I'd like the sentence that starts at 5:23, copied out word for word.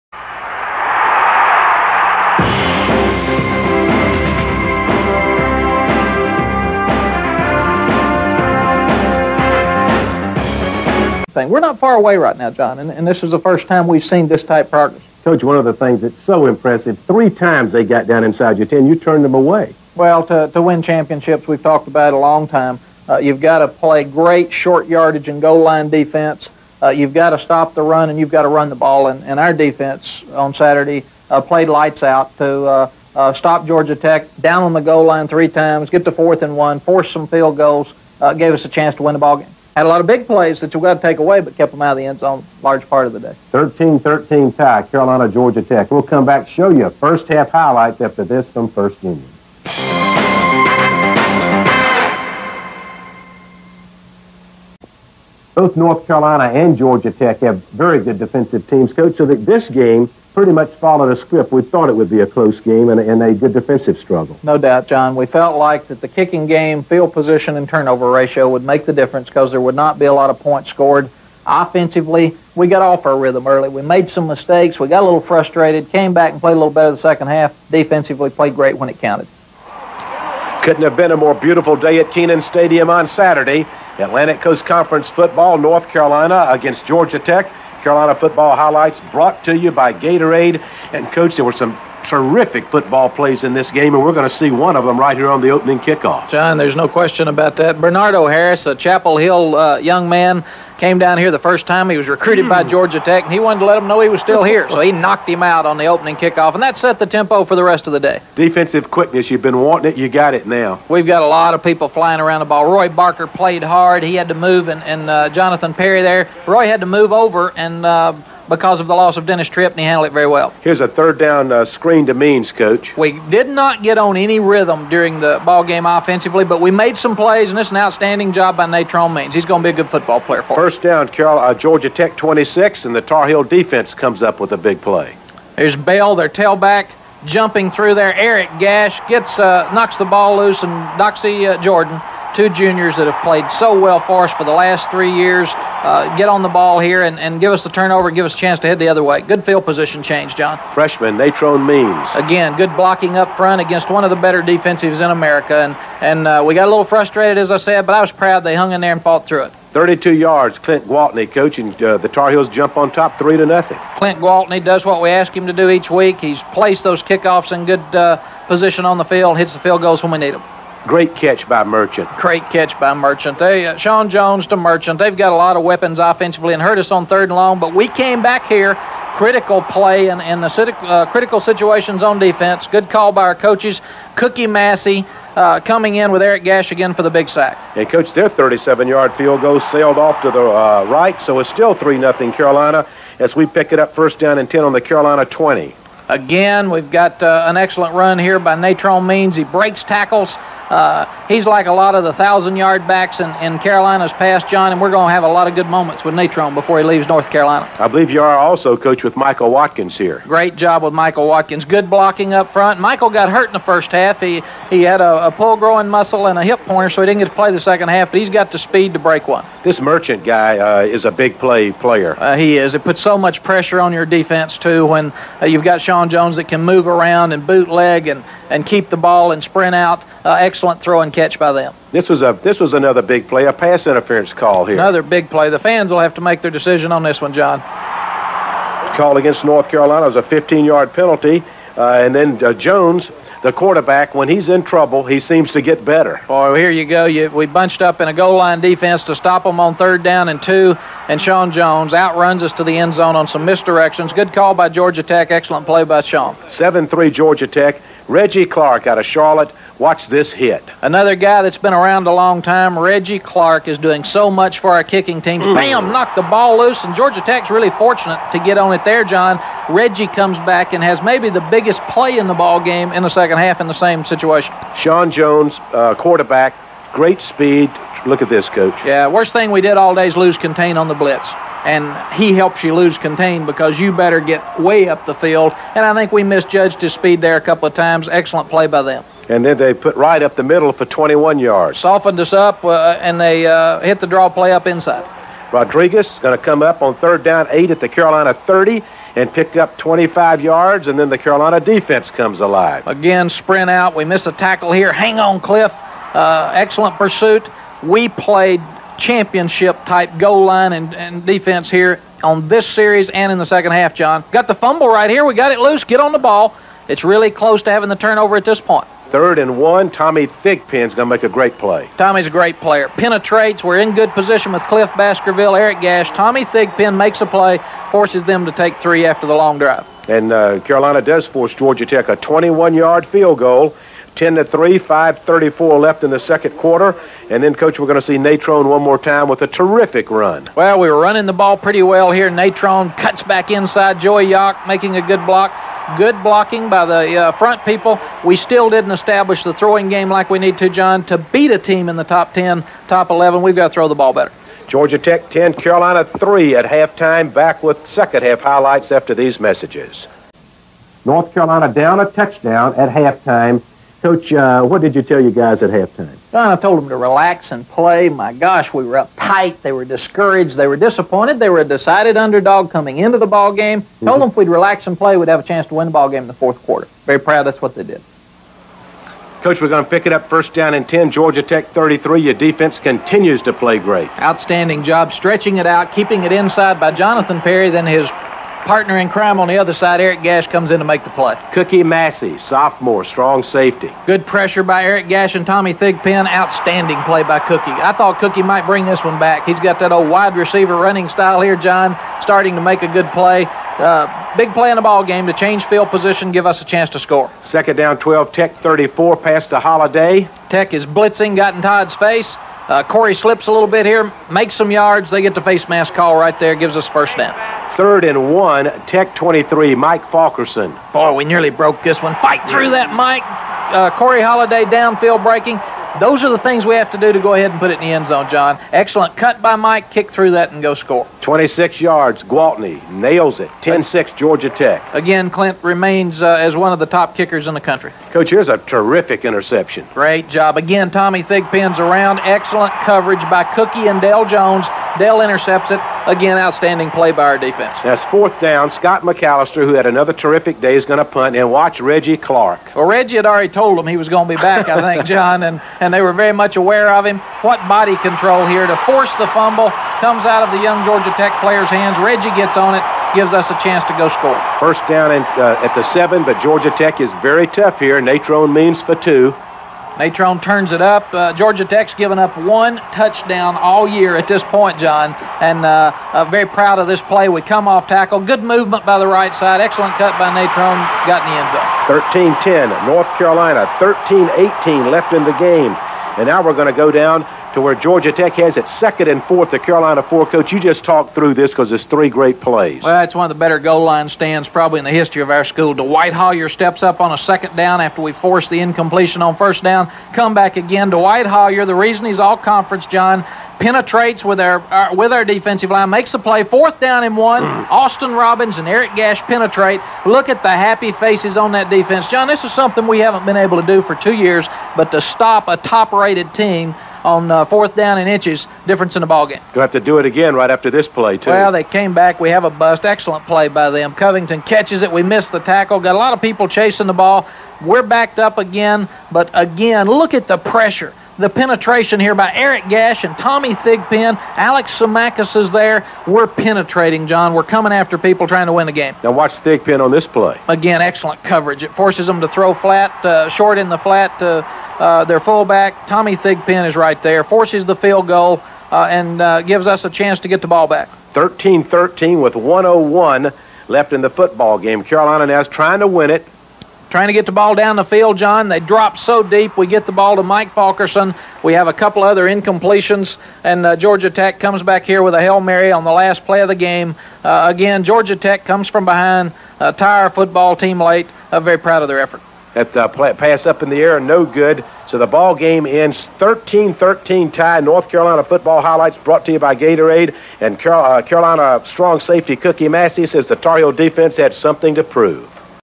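We're in good position with Cliff Baskerville, Eric Gash.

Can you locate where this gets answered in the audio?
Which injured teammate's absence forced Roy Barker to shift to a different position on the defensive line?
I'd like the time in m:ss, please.
1:59.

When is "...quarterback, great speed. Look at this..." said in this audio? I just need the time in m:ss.
4:35.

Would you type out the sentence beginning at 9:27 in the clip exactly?
Uh, again, Georgia Tech comes from behind, uh, tie our football team late.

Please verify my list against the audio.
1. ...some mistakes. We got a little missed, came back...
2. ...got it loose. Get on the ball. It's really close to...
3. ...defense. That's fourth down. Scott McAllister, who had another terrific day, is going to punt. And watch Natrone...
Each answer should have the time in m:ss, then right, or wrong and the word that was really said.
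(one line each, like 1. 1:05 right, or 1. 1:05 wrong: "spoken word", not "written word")
1. 1:14 wrong: "frustrated", not "missed"
2. 5:15 right
3. 7:27 wrong: "Reggie", not "Natrone".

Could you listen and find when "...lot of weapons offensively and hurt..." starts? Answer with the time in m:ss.
2:55.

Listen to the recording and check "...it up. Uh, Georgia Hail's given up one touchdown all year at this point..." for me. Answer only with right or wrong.
wrong.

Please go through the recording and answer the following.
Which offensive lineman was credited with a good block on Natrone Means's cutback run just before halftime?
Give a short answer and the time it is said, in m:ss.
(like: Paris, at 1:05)
Joey Yock, at 5:43.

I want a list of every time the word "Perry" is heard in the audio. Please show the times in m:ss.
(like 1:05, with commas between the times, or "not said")
1:55, 6:27.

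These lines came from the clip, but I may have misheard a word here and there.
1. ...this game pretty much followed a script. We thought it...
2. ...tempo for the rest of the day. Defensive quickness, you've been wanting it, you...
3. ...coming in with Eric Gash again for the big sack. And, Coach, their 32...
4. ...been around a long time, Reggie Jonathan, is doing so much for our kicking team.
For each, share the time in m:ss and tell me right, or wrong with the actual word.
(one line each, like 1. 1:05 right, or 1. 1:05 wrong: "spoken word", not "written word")
1. 0:59 right
2. 1:47 right
3. 3:05 wrong: "37", not "32"
4. 4:21 wrong: "Clark", not "Jonathan".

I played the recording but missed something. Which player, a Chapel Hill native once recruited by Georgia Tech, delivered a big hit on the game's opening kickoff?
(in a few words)
Bernardo Harris.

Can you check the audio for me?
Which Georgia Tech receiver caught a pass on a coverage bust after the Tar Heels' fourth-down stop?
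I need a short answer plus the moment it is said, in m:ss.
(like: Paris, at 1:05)
Covington, at 8:43.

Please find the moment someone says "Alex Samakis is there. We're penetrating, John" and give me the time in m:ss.
8:54.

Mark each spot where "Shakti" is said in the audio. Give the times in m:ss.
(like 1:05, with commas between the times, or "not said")
not said.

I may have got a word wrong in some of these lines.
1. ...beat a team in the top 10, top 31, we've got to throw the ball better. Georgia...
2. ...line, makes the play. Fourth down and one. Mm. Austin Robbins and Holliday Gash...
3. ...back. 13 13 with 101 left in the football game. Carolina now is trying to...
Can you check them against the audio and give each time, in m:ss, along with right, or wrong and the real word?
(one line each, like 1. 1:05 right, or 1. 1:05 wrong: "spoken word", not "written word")
1. 5:51 wrong: "11", not "31"
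2. 8:25 wrong: "Eric", not "Holliday"
3. 9:10 right.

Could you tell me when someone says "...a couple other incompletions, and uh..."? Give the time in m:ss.
9:21.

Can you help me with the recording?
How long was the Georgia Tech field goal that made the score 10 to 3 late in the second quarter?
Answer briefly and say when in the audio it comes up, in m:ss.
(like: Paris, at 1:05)
21 yards, at 5:32.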